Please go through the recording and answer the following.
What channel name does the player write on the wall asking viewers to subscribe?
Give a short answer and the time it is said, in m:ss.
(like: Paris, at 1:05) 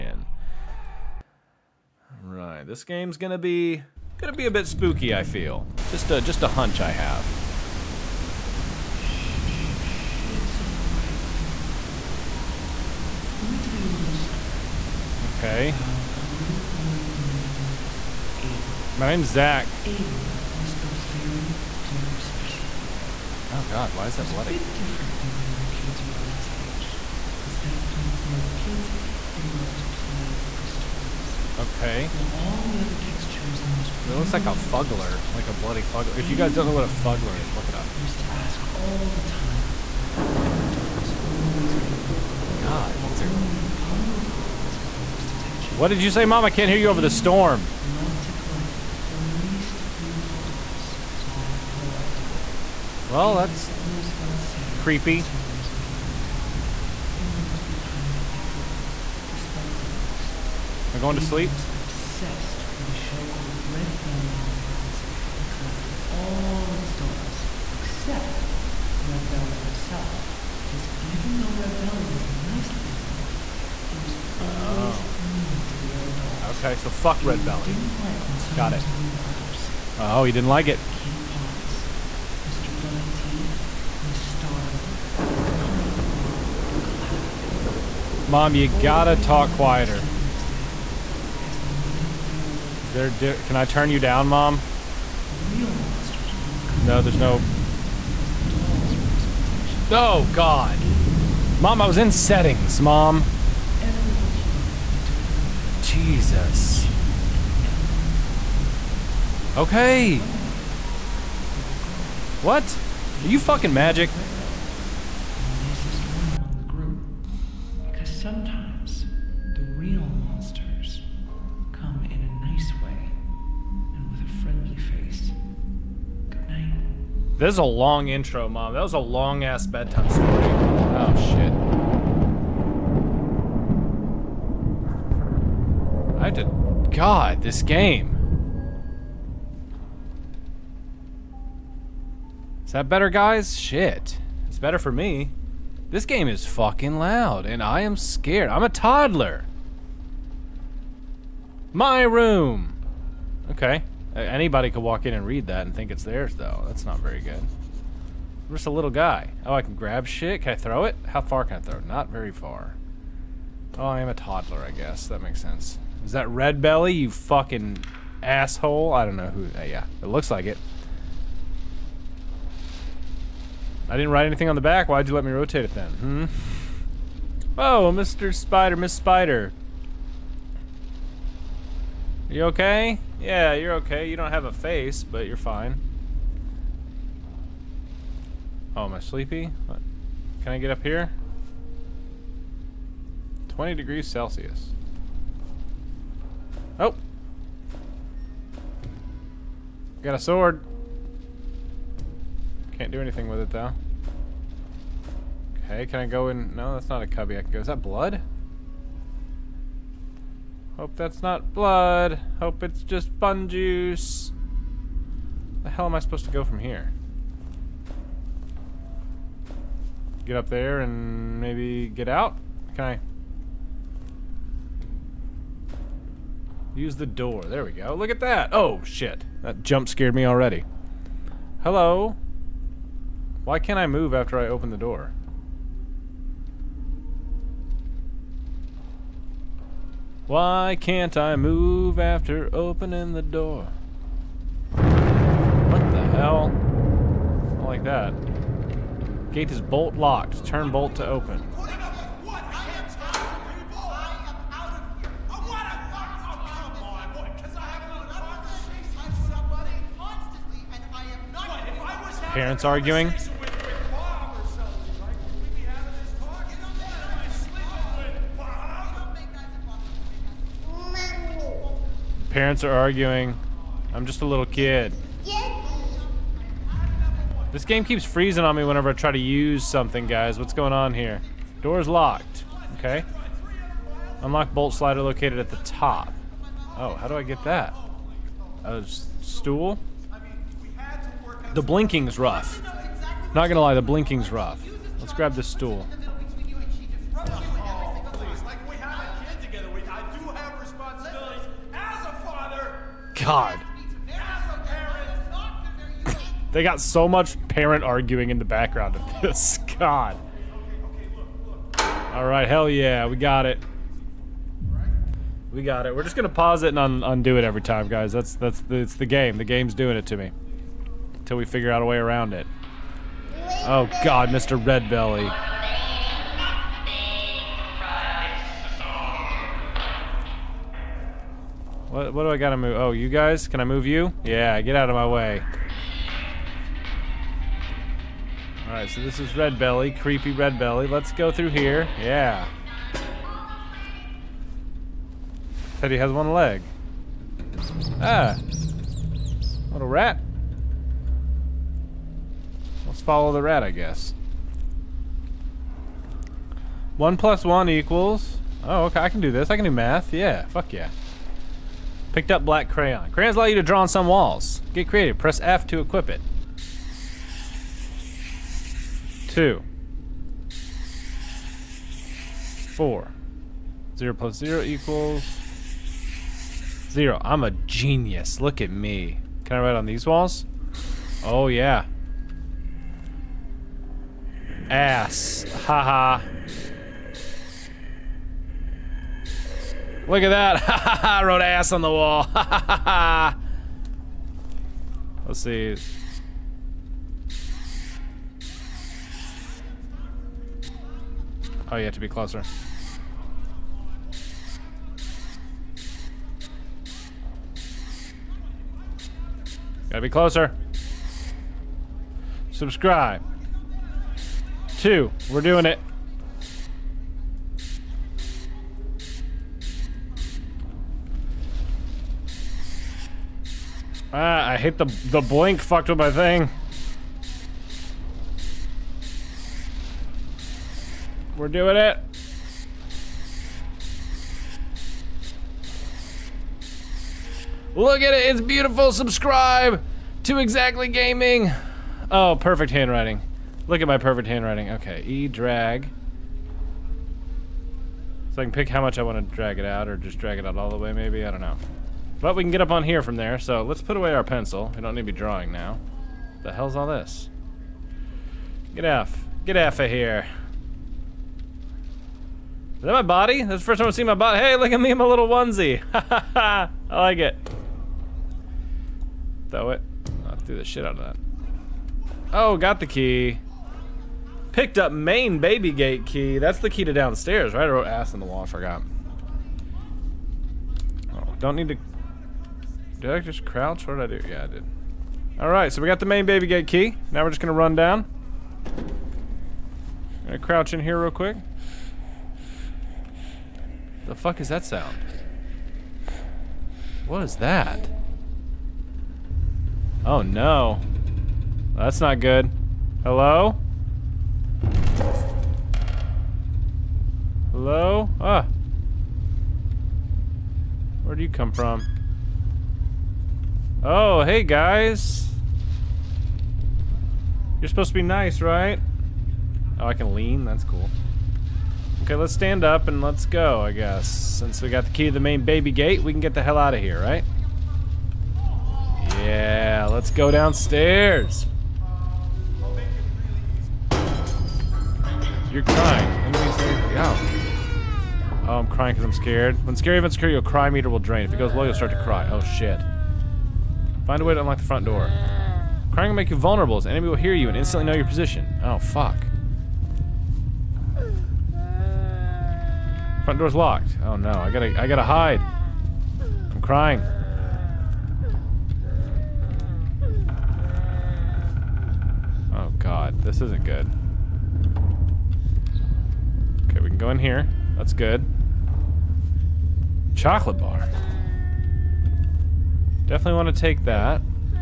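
ExZackly Gaming, at 7:20.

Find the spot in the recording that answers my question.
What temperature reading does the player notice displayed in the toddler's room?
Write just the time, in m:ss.
3:13.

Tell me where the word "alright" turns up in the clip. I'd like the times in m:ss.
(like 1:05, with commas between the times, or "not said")
0:02, 0:10, 5:38, 8:05.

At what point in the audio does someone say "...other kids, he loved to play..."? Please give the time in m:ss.
0:28.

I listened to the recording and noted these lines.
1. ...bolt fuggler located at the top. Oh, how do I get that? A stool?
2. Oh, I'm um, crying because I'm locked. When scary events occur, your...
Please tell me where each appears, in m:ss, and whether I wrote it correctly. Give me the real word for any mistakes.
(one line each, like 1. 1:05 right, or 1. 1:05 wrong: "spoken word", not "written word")
1. 4:44 wrong: "slider", not "fuggler"
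2. 8:58 wrong: "scared", not "locked".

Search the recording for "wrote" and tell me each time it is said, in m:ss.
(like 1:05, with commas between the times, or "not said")
6:31, 7:57.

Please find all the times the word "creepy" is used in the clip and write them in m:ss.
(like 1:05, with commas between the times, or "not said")
0:54, 5:39.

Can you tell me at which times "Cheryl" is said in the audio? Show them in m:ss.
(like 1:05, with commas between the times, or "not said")
not said.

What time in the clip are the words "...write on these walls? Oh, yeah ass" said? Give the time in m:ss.
6:19.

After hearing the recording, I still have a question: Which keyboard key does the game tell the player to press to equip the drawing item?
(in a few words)
F.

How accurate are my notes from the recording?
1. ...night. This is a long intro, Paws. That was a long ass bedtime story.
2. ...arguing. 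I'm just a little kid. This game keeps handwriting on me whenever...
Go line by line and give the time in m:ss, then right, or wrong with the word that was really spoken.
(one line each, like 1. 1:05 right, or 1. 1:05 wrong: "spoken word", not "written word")
1. 2:06 wrong: "Mom", not "Paws"
2. 4:32 wrong: "freezing", not "handwriting".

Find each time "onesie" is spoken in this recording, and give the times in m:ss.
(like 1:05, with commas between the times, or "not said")
7:45.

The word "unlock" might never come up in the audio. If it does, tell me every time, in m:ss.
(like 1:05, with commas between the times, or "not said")
4:44, 9:04.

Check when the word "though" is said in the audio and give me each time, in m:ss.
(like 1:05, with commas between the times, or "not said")
1:11, 2:36, 3:23.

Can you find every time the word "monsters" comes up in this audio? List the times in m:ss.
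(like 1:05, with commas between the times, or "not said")
1:35, 2:00.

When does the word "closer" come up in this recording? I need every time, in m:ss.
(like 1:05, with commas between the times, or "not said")
6:42, 6:50.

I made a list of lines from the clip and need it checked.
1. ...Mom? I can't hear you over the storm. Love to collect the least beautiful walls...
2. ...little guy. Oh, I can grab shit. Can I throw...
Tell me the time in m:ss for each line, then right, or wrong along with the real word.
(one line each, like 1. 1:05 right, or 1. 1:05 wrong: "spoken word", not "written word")
1. 0:46 wrong: "dolls", not "walls"
2. 2:38 right.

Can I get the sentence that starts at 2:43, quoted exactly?
Oh, I am a toddler, I guess.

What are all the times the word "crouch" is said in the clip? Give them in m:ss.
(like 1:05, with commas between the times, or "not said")
8:03, 8:10.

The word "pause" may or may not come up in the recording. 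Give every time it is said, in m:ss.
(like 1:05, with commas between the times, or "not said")
5:16.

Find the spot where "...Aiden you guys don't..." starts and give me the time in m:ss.
0:36.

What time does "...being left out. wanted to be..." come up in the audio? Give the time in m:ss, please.
0:55.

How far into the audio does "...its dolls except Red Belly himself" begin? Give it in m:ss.
1:06.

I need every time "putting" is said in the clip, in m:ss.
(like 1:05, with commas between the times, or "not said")
not said.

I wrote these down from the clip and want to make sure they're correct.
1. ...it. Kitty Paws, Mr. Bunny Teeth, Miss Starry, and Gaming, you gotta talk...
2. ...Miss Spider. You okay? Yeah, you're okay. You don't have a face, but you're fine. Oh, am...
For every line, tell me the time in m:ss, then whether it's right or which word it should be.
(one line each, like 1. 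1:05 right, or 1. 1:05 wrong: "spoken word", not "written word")
1. 1:20 wrong: "Mom", not "Gaming"
2. 2:58 right.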